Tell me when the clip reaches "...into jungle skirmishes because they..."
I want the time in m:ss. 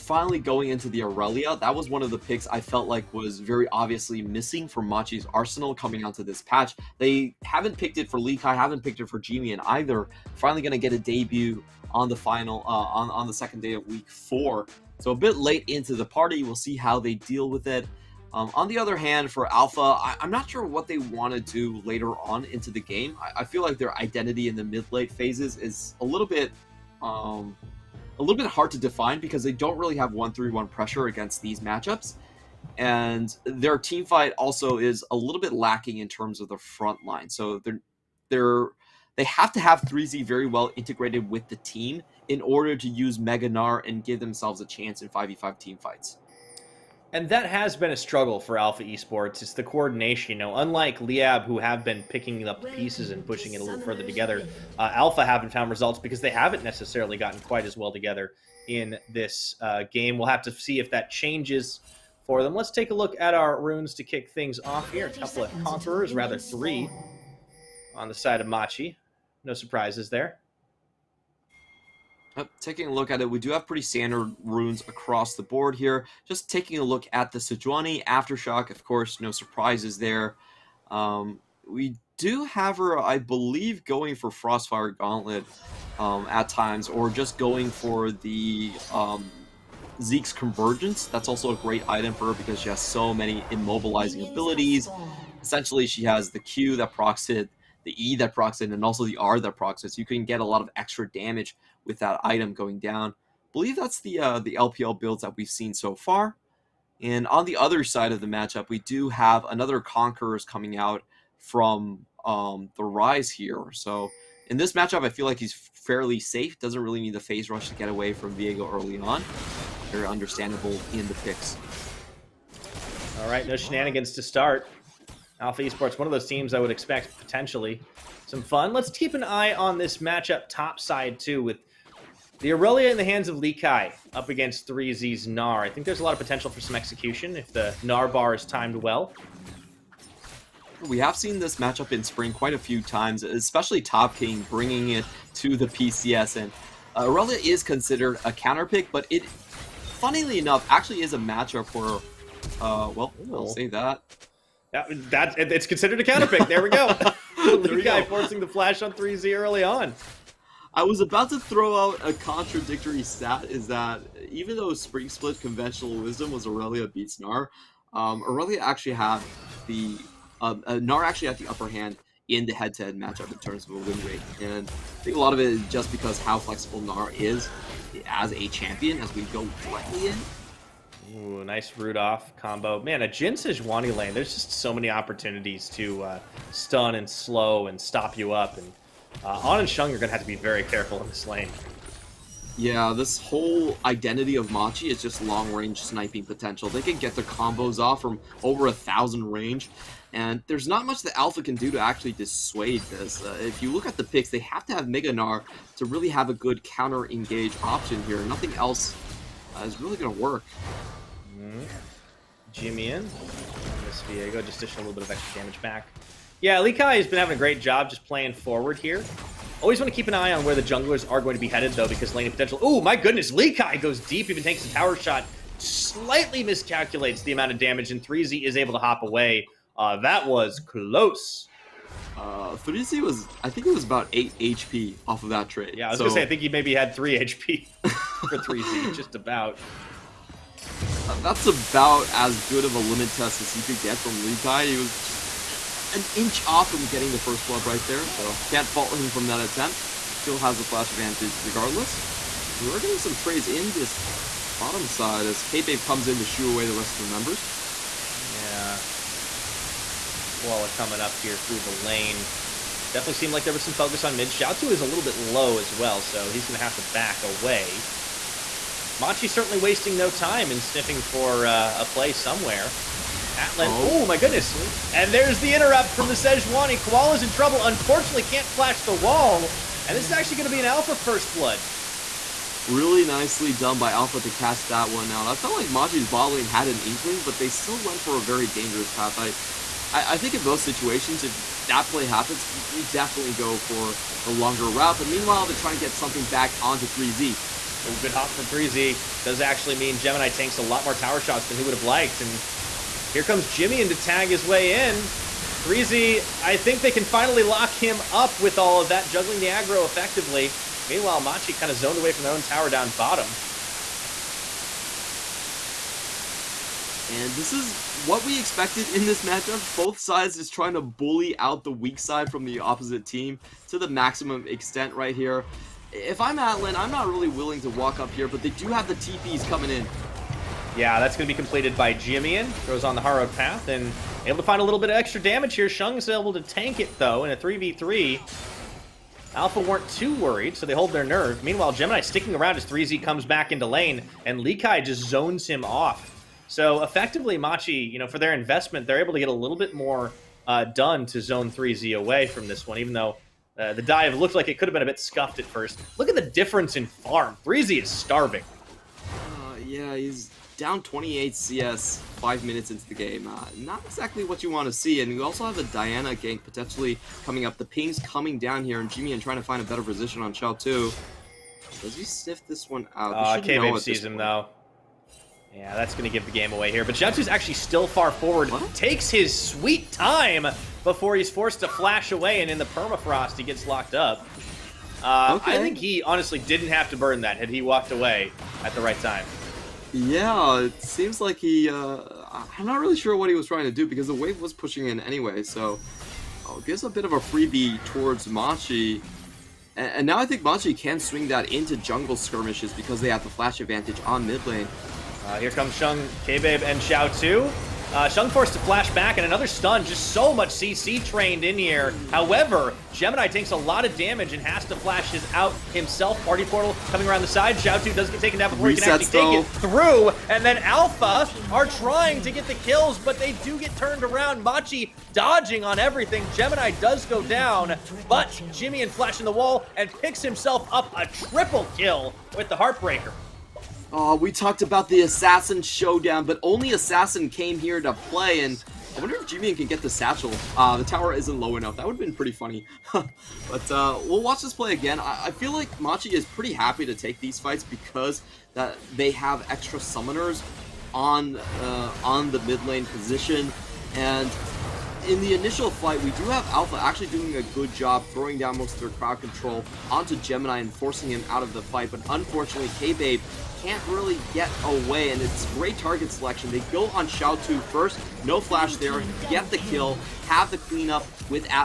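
6:41.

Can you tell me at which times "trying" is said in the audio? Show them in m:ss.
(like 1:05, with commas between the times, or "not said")
4:55, 5:20, 6:09, 6:33, 7:01.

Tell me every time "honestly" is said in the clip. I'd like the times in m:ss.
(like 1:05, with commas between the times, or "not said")
6:26.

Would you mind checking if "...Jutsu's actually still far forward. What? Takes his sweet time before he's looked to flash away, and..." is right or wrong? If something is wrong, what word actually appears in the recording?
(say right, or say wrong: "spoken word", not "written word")
wrong: "forced", not "looked".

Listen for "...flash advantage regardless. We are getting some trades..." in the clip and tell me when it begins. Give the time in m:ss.
4:10.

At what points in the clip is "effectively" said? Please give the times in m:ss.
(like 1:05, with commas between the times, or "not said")
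5:09, 5:46.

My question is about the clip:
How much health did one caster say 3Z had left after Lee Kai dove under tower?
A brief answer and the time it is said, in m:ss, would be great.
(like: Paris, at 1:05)
8, at 3:54.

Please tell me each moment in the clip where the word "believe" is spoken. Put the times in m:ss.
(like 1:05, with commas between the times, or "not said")
1:23, 1:43.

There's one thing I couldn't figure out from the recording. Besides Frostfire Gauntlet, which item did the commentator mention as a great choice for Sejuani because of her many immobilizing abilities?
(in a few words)
Zeke's Convergence.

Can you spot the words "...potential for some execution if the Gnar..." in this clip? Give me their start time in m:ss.
2:16.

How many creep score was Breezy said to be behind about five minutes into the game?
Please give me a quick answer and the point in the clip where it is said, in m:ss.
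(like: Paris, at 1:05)
28, at 6:00.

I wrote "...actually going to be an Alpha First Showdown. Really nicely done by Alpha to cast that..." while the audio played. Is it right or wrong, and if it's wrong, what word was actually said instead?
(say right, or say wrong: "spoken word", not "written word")
wrong: "Blood", not "Showdown".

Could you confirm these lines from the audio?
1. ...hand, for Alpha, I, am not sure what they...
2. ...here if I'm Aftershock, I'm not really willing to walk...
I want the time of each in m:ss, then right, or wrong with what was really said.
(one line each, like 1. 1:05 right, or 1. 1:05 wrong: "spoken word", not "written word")
1. 0:18 right
2. 5:25 wrong: "Atlan", not "Aftershock".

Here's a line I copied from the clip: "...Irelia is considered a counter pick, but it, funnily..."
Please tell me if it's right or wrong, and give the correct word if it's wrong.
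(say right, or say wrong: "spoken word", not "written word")
right.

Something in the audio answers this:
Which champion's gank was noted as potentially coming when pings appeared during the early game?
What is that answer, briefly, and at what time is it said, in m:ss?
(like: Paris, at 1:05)
Diana, at 6:05.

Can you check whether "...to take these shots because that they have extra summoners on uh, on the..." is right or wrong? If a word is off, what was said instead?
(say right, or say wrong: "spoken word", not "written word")
wrong: "fights", not "shots".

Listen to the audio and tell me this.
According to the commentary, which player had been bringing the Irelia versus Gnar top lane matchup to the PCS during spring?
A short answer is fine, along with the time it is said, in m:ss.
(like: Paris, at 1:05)
Top King, at 2:23.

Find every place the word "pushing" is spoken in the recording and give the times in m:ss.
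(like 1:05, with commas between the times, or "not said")
0:53, 6:34.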